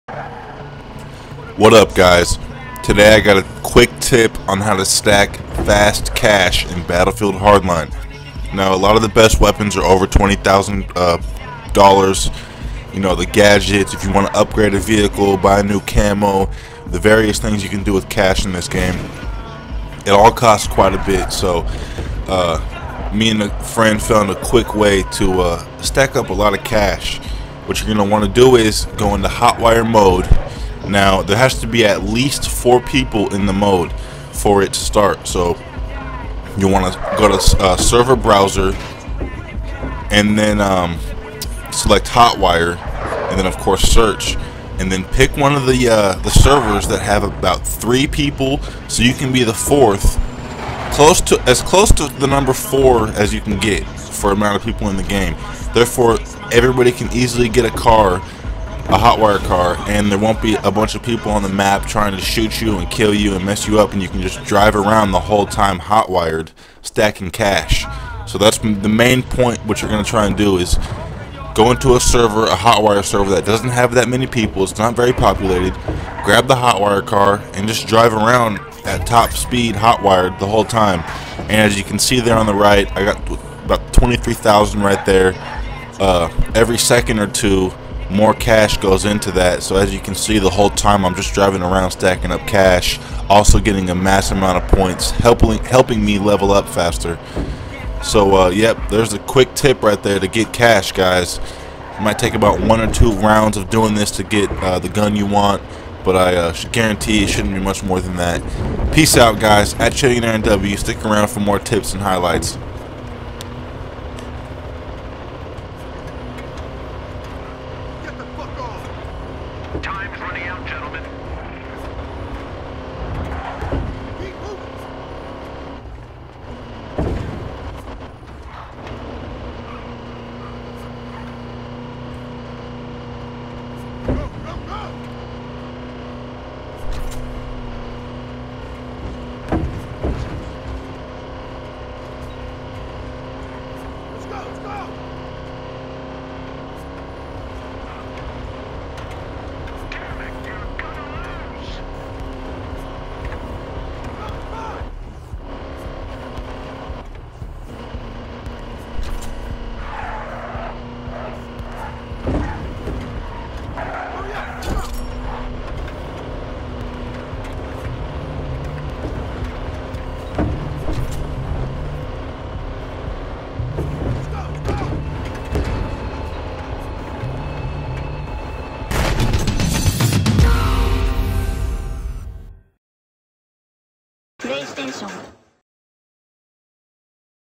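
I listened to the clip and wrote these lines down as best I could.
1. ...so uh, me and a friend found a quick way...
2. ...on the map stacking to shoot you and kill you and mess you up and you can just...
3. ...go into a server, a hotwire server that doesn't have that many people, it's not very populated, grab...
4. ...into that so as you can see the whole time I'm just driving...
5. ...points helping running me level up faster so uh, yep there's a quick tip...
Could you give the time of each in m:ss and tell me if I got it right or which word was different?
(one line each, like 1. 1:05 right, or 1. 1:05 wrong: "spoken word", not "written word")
1. 0:21 right
2. 1:01 wrong: "trying", not "stacking"
3. 1:11 right
4. 1:29 right
5. 1:34 wrong: "helping", not "running".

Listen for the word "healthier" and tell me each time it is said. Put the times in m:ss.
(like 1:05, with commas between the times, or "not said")
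not said.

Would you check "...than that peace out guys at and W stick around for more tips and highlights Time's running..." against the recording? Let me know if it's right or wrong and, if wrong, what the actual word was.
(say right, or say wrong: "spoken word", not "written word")
right.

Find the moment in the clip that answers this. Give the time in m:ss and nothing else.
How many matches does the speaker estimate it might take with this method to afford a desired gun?
1:42.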